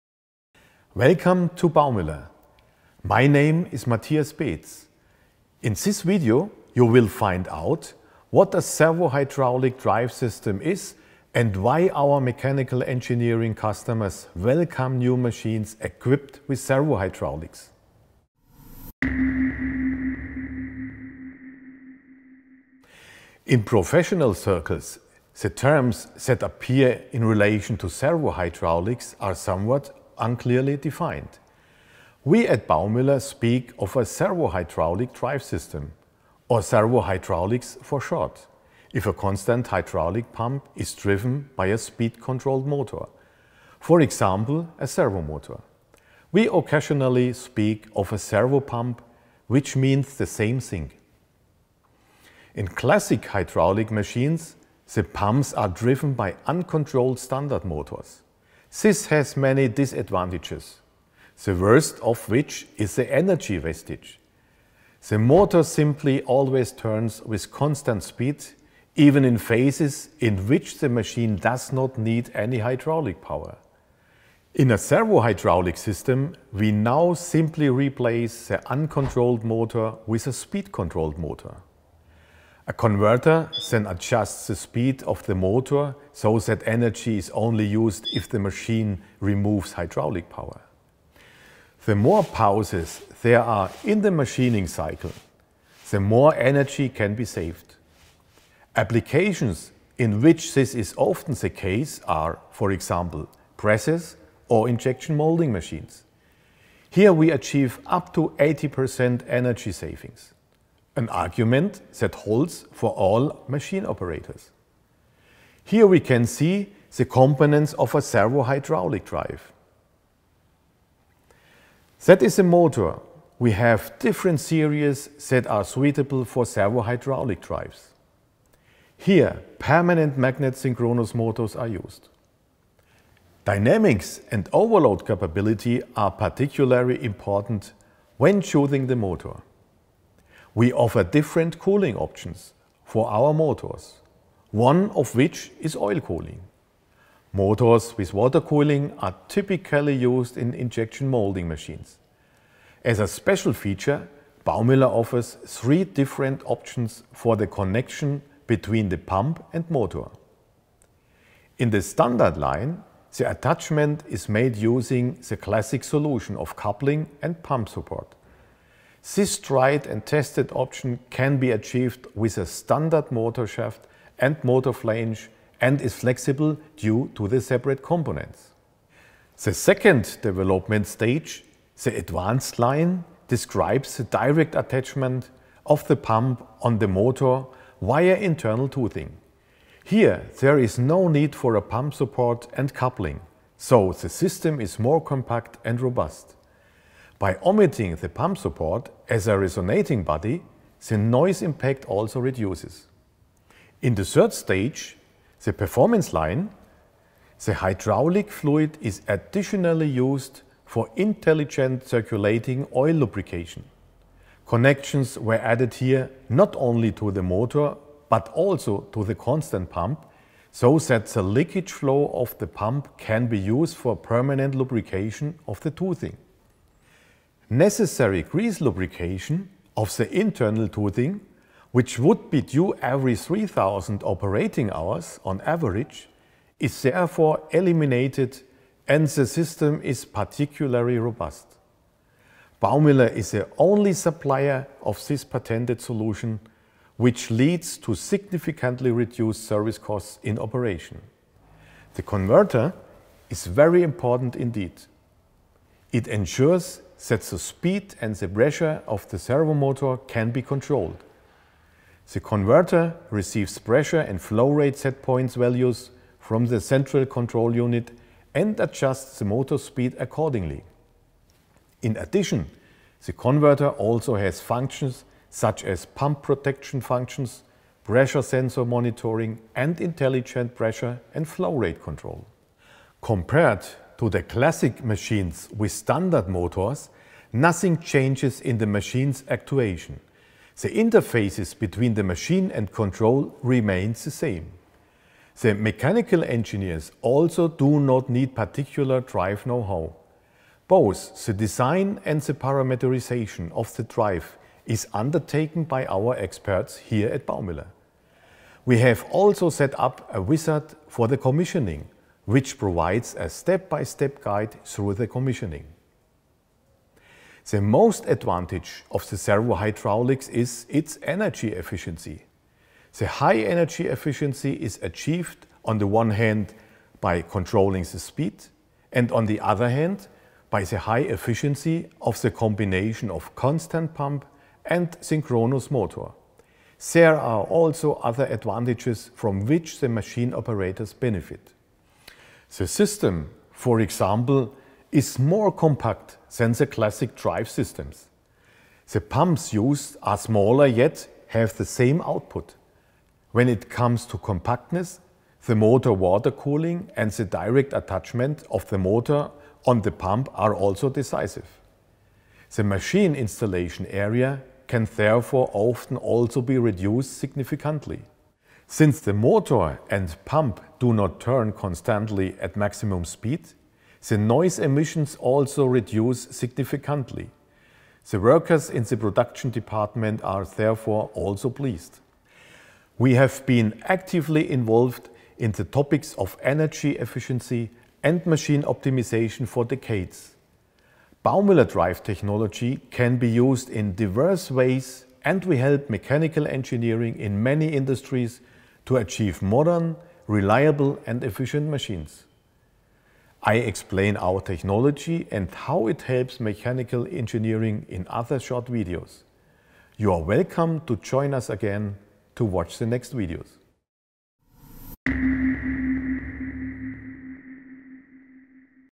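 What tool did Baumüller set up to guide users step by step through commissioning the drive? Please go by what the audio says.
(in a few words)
A wizard.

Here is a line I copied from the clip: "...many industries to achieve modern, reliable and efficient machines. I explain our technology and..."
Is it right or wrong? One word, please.
right.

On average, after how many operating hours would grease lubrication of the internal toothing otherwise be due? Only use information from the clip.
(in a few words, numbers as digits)
3000.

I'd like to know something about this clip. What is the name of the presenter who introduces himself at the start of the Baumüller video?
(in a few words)
Matthias Beetz.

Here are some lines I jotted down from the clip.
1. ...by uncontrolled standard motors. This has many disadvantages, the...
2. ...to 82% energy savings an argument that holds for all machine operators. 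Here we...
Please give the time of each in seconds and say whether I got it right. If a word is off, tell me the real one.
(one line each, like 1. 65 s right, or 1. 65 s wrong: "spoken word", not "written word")
1. 56 s right
2. 108 s wrong: "80", not "82".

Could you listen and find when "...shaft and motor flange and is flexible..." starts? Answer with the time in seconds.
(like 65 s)
173 s.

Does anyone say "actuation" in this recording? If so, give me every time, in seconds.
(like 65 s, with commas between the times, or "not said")
289 s.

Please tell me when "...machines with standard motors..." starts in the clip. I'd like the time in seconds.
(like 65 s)
284 s.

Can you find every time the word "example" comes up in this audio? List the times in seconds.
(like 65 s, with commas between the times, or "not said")
44 s, 102 s, 343 s.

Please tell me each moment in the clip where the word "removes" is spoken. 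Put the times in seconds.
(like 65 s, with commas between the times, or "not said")
89 s.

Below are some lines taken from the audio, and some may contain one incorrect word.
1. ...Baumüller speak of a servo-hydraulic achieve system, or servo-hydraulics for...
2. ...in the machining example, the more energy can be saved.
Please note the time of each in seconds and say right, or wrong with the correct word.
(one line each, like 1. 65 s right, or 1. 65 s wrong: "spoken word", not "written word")
1. 32 s wrong: "drive", not "achieve"
2. 93 s wrong: "cycle", not "example".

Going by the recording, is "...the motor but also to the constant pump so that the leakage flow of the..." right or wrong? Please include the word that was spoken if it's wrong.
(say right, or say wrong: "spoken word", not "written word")
right.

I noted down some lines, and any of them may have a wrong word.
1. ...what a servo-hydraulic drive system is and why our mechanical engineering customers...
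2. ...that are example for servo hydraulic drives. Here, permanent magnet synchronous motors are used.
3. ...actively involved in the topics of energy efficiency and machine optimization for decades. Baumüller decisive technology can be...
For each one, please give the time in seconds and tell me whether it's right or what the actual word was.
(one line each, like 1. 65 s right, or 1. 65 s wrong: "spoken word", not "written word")
1. 8 s right
2. 125 s wrong: "suitable", not "example"
3. 383 s wrong: "drive", not "decisive".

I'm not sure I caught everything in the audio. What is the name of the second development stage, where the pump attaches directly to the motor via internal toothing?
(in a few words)
Advanced line.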